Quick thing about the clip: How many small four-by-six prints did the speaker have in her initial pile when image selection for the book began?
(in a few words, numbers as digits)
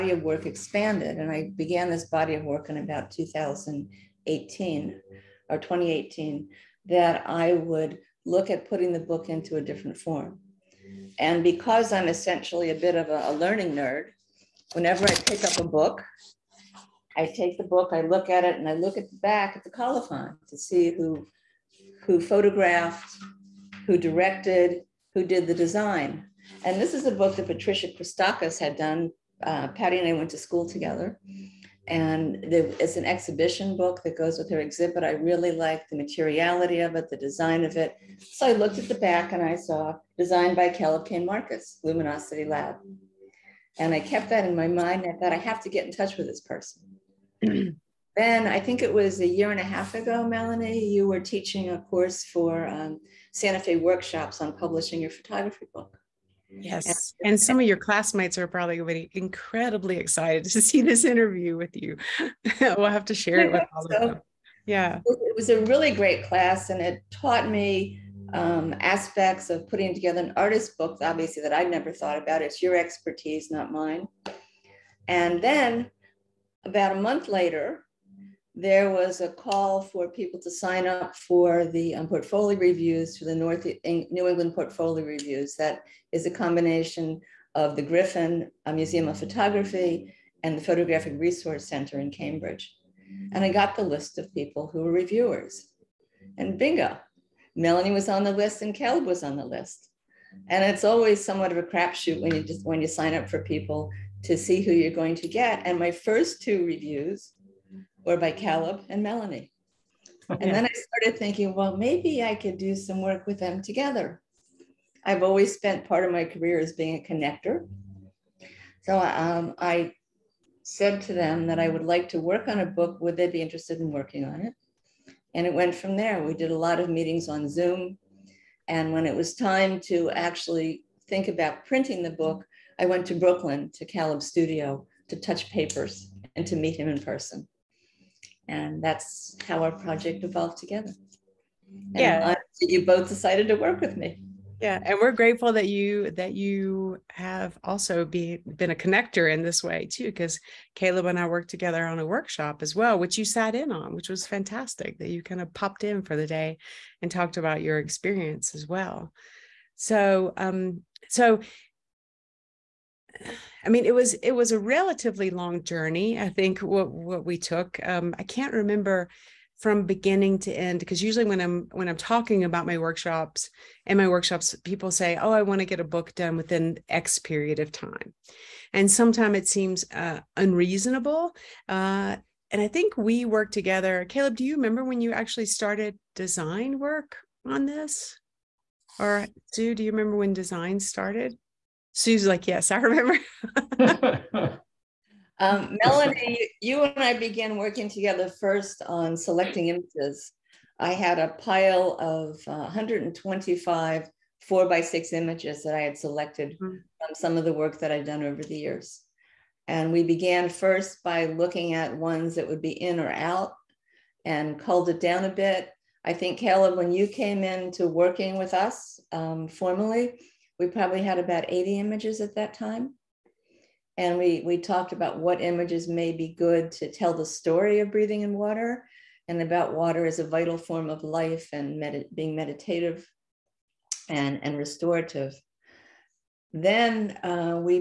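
125.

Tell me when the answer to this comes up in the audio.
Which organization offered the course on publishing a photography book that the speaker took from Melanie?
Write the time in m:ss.
0:53.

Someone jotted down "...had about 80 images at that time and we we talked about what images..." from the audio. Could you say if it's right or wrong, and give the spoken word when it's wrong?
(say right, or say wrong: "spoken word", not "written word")
right.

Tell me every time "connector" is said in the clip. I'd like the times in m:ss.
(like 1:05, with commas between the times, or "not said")
1:57, 2:28.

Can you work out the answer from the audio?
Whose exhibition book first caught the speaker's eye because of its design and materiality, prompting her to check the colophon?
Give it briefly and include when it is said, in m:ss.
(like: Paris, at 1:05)
Patricia Christakis, at 0:27.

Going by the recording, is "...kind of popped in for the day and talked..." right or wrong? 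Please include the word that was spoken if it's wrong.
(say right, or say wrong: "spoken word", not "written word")
right.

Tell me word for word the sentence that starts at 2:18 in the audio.
And that's how our project evolved together.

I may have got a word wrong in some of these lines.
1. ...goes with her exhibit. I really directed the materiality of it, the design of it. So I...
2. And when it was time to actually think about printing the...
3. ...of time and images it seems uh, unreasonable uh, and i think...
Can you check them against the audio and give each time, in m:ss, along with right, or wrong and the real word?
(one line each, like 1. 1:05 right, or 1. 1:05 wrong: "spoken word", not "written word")
1. 0:34 wrong: "liked", not "directed"
2. 2:08 right
3. 2:57 wrong: "sometimes", not "images".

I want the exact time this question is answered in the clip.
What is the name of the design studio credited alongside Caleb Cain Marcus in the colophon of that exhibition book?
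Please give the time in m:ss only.
0:41.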